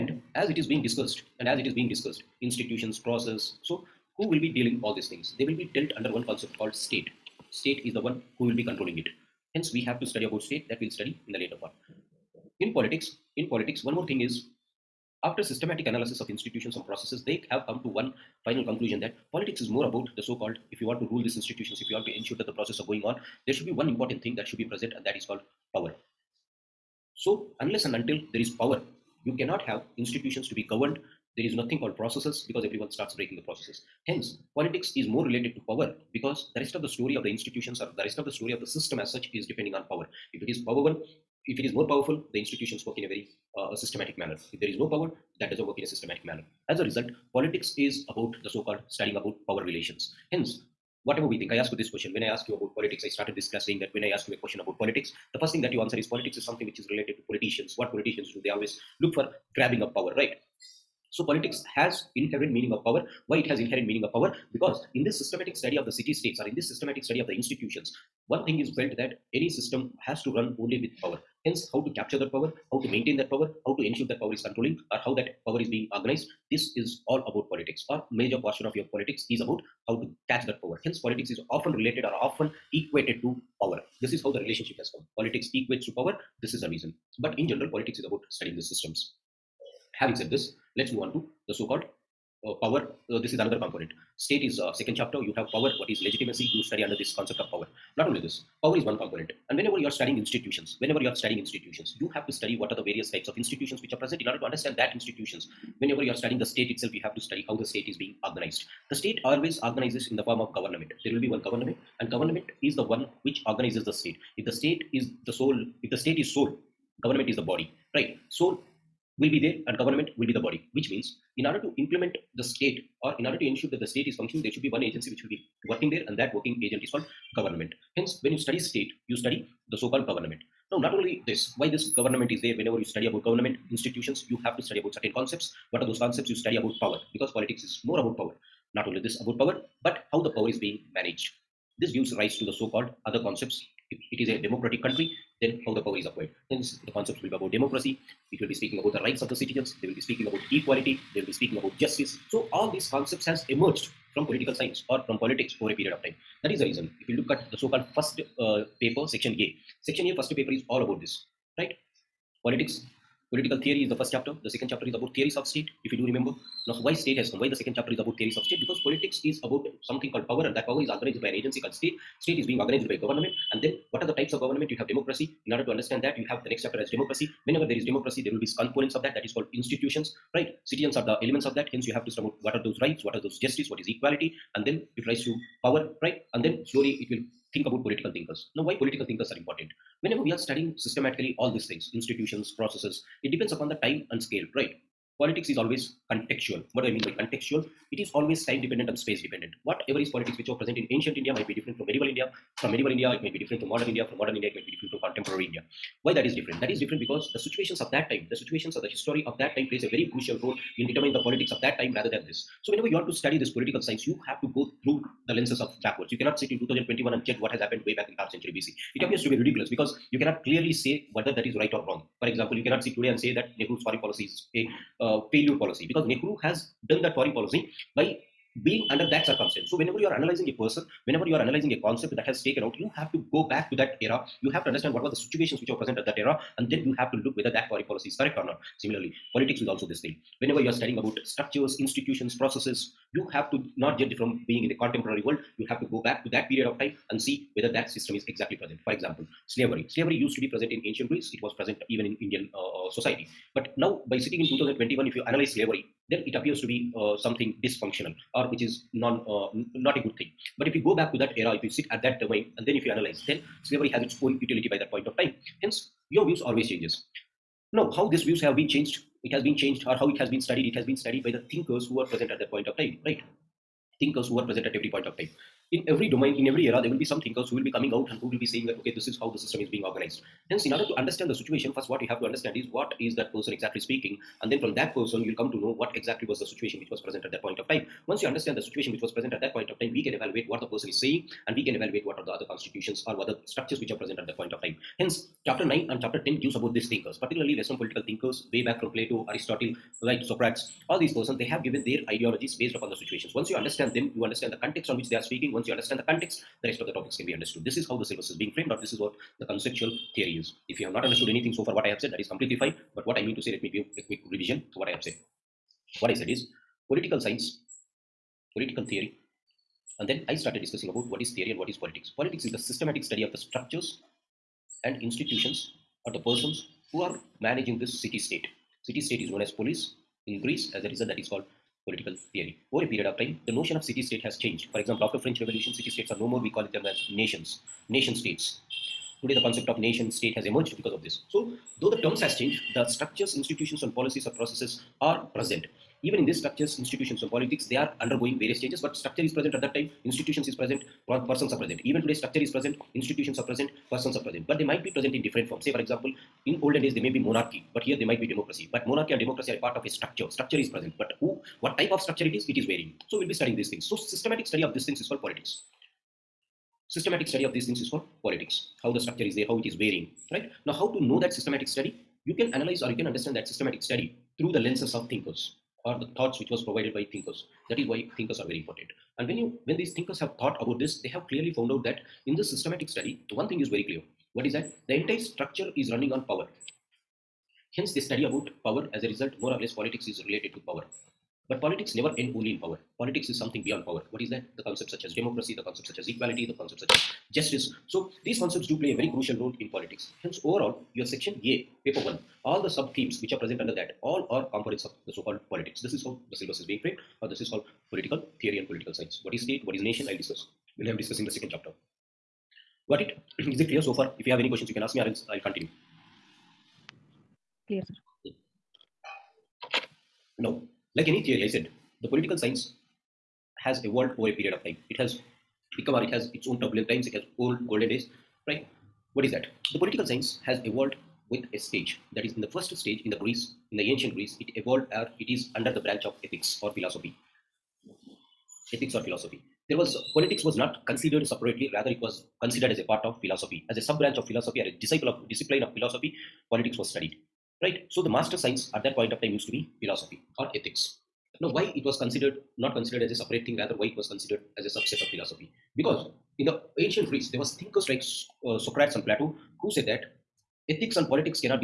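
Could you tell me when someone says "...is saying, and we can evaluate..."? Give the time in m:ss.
4:50.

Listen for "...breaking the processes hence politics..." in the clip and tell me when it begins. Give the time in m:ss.
0:33.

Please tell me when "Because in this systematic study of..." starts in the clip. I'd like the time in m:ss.
1:04.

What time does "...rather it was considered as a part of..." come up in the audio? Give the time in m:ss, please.
7:21.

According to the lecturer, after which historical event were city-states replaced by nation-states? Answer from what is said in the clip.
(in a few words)
French Revolution.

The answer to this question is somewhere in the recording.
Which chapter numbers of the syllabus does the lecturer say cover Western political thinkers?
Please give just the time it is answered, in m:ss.
4:55.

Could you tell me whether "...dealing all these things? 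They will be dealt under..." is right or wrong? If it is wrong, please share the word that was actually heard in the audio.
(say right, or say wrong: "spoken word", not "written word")
right.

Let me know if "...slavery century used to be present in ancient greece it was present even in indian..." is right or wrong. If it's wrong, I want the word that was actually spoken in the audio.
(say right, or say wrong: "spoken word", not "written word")
wrong: "slavery", not "century".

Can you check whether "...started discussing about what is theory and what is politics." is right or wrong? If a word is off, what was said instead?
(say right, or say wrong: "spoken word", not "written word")
right.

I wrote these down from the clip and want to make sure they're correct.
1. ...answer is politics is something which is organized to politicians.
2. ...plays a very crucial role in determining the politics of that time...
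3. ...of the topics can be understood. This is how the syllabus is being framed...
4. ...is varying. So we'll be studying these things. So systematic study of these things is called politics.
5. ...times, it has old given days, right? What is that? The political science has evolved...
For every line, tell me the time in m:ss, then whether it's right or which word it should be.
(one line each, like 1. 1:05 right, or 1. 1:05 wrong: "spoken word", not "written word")
1. 0:55 wrong: "related", not "organized"
2. 3:29 right
3. 5:06 right
4. 6:02 right
5. 7:06 wrong: "golden", not "given".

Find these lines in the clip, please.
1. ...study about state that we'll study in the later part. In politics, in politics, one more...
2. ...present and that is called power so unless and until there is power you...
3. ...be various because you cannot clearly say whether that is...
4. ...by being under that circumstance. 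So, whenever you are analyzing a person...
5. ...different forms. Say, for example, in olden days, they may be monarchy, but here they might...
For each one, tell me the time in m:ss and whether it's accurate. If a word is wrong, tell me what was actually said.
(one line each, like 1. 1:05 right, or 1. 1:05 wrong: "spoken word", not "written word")
1. 0:10 right
2. 0:24 right
3. 3:39 wrong: "ridiculous", not "various"
4. 3:47 right
5. 5:55 right.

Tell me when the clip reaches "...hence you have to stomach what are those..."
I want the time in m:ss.
3:01.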